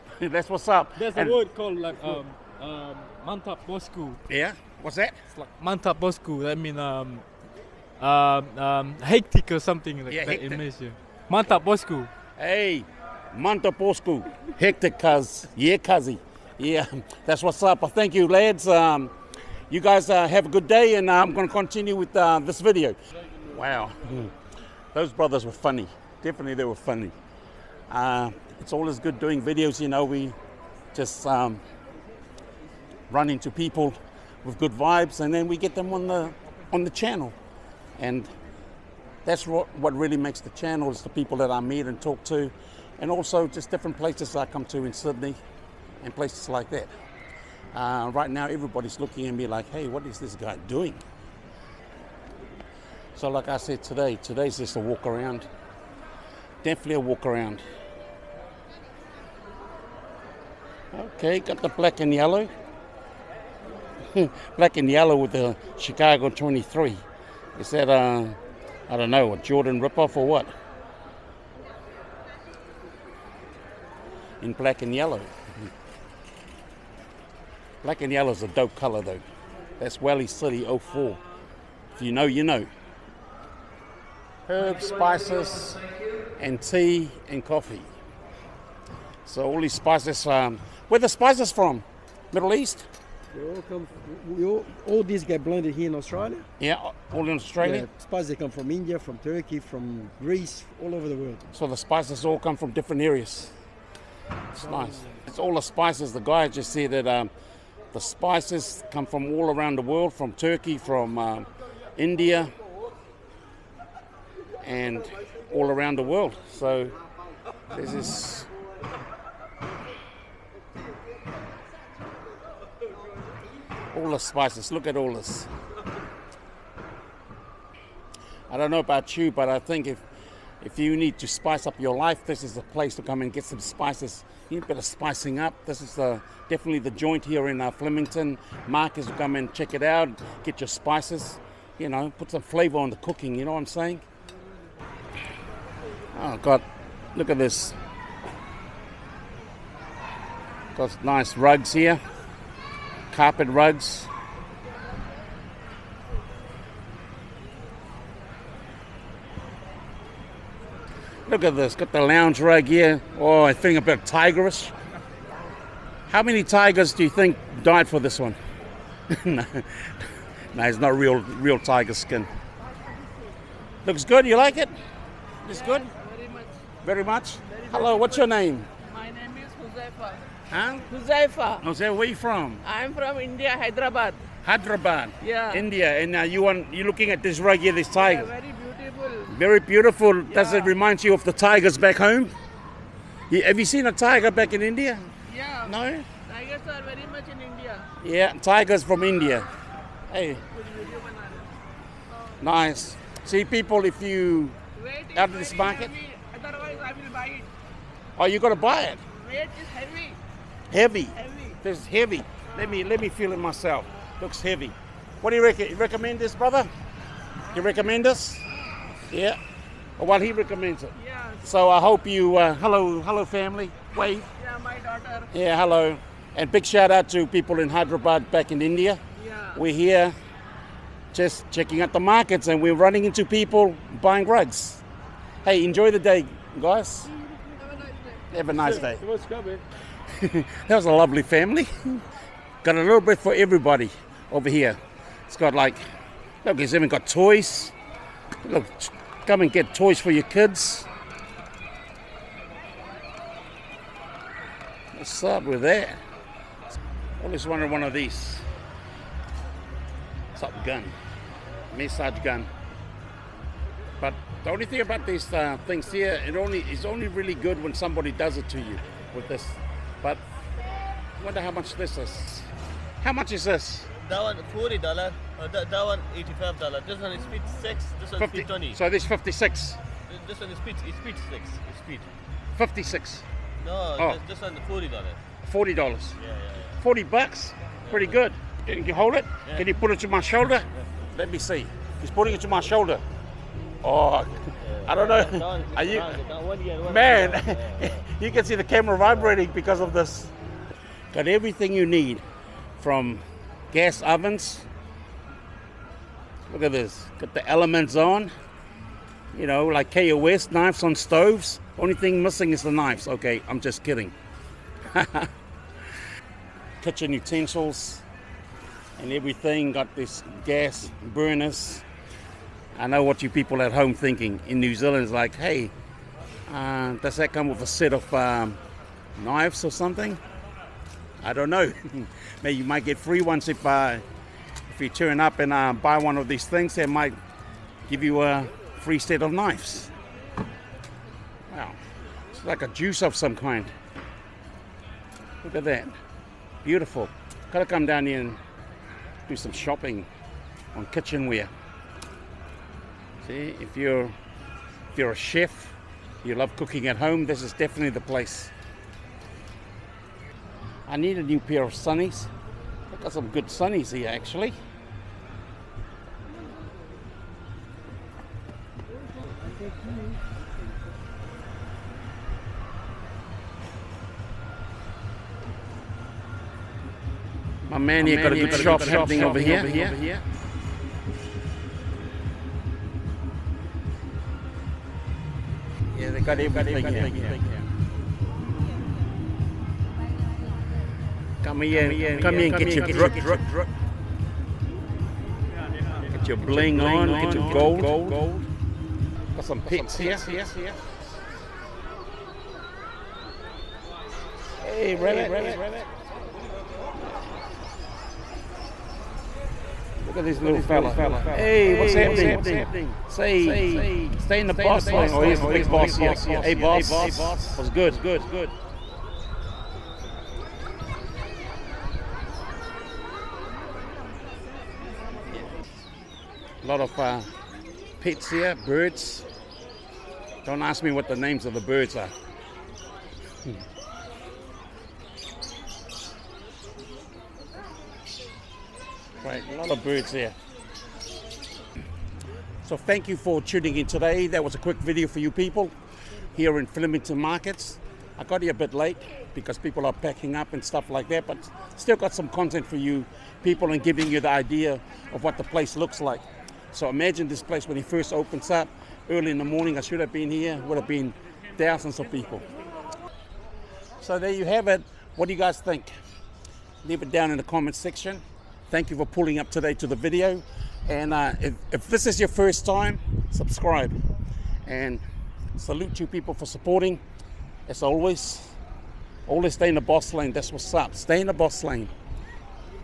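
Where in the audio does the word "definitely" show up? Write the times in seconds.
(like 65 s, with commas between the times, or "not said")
26 s, 56 s, 136 s, 357 s.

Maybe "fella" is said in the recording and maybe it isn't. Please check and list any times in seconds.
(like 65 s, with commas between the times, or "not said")
410 s.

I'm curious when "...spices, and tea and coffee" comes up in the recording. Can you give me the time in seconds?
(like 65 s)
84 s.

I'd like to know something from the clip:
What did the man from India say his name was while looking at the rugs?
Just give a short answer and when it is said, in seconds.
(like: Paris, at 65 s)
Huzaifa, at 180 s.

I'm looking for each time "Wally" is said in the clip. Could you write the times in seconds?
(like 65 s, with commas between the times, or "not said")
80 s.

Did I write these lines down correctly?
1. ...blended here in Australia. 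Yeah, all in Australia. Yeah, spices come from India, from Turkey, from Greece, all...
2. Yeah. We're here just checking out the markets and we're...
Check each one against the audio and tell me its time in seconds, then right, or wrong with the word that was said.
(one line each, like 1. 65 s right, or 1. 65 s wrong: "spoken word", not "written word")
1. 95 s right
2. 229 s right.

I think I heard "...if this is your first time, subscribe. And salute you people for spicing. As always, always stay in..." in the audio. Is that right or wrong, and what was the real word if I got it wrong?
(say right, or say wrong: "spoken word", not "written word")
wrong: "supporting", not "spicing".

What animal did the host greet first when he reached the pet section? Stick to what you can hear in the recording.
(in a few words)
Rabbit.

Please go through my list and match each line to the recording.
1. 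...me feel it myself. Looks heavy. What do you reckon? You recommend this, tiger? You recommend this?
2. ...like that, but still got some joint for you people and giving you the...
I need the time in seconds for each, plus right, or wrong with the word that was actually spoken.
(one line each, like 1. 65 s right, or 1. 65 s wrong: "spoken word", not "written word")
1. 213 s wrong: "brother", not "tiger"
2. 450 s wrong: "content", not "joint".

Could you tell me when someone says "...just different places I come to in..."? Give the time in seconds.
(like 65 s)
43 s.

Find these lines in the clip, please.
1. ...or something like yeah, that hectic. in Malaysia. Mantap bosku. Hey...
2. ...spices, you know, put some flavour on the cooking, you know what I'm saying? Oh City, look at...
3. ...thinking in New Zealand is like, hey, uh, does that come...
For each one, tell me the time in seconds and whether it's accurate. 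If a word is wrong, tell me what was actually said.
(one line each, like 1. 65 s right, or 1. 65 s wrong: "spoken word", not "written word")
1. 9 s right
2. 140 s wrong: "God", not "City"
3. 323 s right.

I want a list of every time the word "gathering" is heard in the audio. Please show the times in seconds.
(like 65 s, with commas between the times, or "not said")
not said.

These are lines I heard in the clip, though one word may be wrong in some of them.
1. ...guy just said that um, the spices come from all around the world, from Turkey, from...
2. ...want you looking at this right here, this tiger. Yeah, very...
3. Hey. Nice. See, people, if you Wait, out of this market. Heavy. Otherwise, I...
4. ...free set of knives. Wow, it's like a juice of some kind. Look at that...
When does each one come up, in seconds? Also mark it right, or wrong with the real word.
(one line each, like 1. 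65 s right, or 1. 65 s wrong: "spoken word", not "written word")
1. 106 s right
2. 186 s right
3. 200 s right
4. 338 s right.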